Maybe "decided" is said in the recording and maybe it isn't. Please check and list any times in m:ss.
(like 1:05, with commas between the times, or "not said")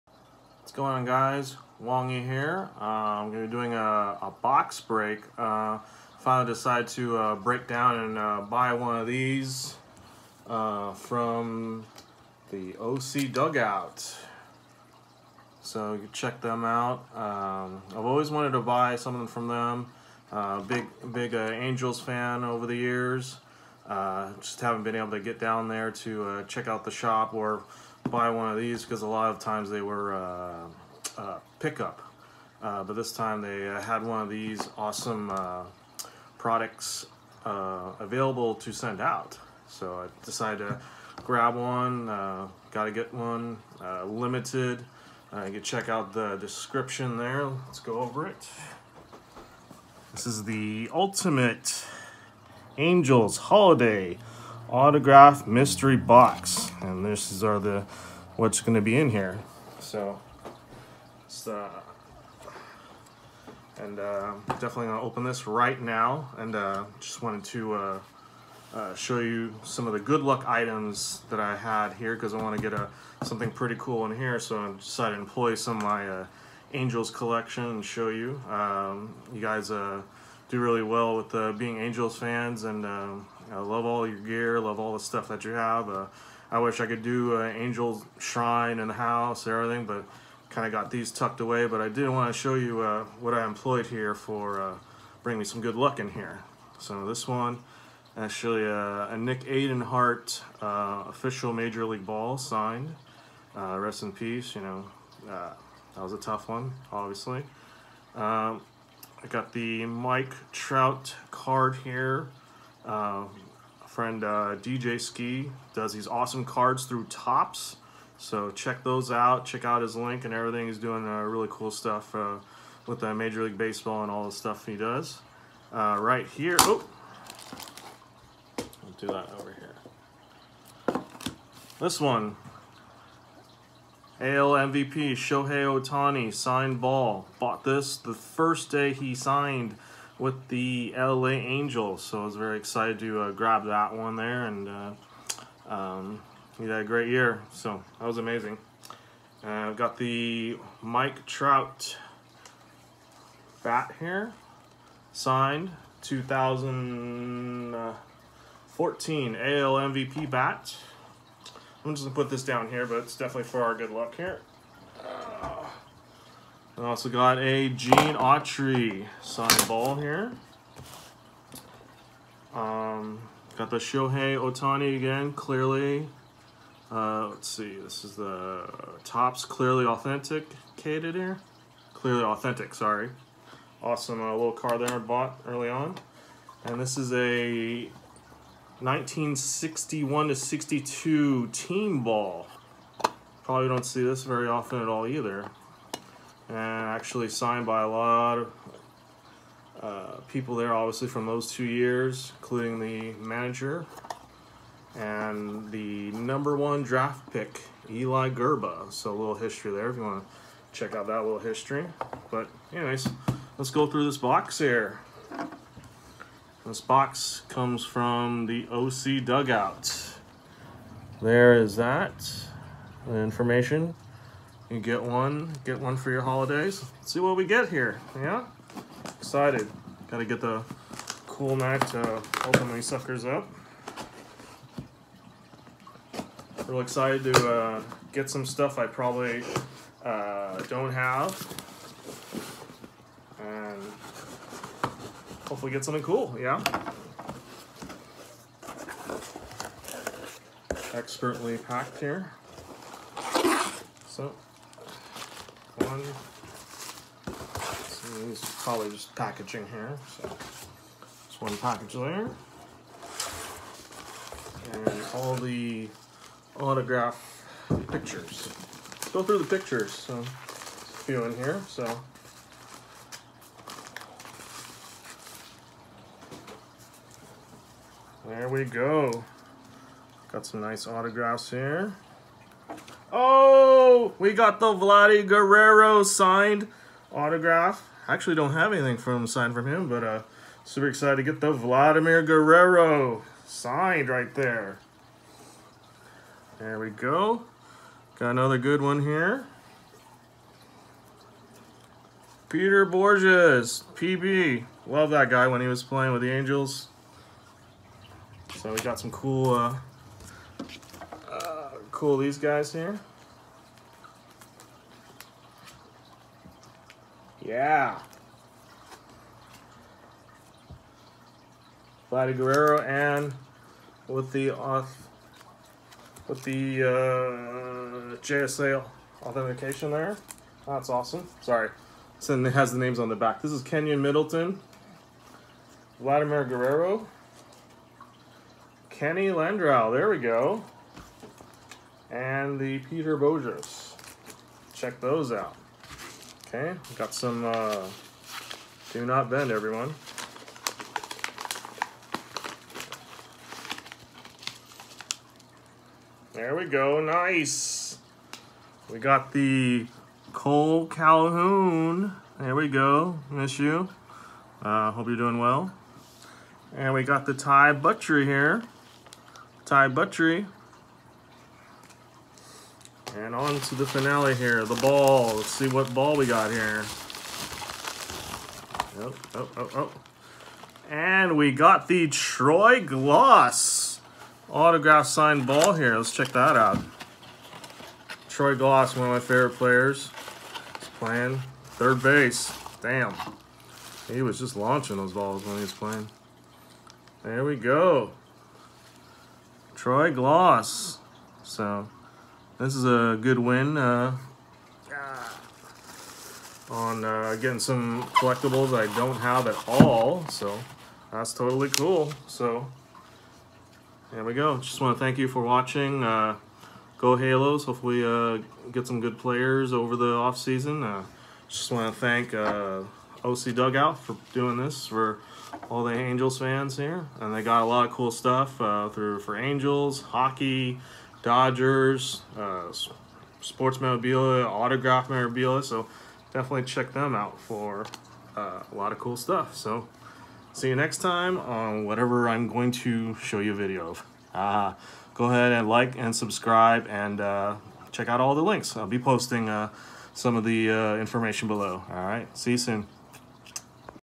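0:06, 0:40, 1:14.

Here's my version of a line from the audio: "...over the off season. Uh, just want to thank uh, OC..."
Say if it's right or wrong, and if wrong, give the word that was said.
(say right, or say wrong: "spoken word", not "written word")
right.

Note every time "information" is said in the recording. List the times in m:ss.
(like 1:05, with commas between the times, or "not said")
3:43, 7:30.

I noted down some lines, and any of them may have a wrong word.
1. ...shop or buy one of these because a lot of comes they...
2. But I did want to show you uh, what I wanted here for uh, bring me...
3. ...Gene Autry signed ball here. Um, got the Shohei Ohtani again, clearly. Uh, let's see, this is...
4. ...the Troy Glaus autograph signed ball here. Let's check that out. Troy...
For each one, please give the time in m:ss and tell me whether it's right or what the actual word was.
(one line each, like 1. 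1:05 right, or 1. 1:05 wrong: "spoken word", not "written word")
1. 0:26 wrong: "times", not "comes"
2. 1:31 wrong: "employed", not "wanted"
3. 2:47 right
4. 6:21 right.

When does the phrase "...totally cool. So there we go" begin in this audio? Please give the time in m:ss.
6:51.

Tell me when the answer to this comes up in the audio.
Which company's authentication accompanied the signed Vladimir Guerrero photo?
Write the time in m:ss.
5:28.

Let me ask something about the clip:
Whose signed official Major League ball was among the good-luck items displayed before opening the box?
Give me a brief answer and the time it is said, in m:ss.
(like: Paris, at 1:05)
Nick Adenhart, at 1:39.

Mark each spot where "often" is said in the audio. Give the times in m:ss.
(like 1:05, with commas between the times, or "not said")
3:14.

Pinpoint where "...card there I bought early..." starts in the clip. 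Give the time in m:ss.
3:04.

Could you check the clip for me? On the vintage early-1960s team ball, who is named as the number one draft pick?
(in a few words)
Eli Grba.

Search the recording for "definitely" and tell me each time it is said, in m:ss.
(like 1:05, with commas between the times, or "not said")
1:04, 2:43, 7:16.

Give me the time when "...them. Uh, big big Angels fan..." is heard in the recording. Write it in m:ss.
0:19.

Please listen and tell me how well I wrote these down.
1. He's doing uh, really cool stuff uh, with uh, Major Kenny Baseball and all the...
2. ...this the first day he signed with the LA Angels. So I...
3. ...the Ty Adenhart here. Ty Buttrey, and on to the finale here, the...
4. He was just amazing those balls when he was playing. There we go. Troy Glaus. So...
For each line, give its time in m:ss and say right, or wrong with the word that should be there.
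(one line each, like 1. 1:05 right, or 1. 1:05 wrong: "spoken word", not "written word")
1. 2:00 wrong: "League", not "Kenny"
2. 2:17 right
3. 6:07 wrong: "Buttrey", not "Adenhart"
4. 6:34 wrong: "launching", not "amazing".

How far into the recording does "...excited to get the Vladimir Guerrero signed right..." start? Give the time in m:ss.
4:50.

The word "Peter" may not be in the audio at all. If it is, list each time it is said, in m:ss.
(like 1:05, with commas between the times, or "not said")
5:02, 5:42.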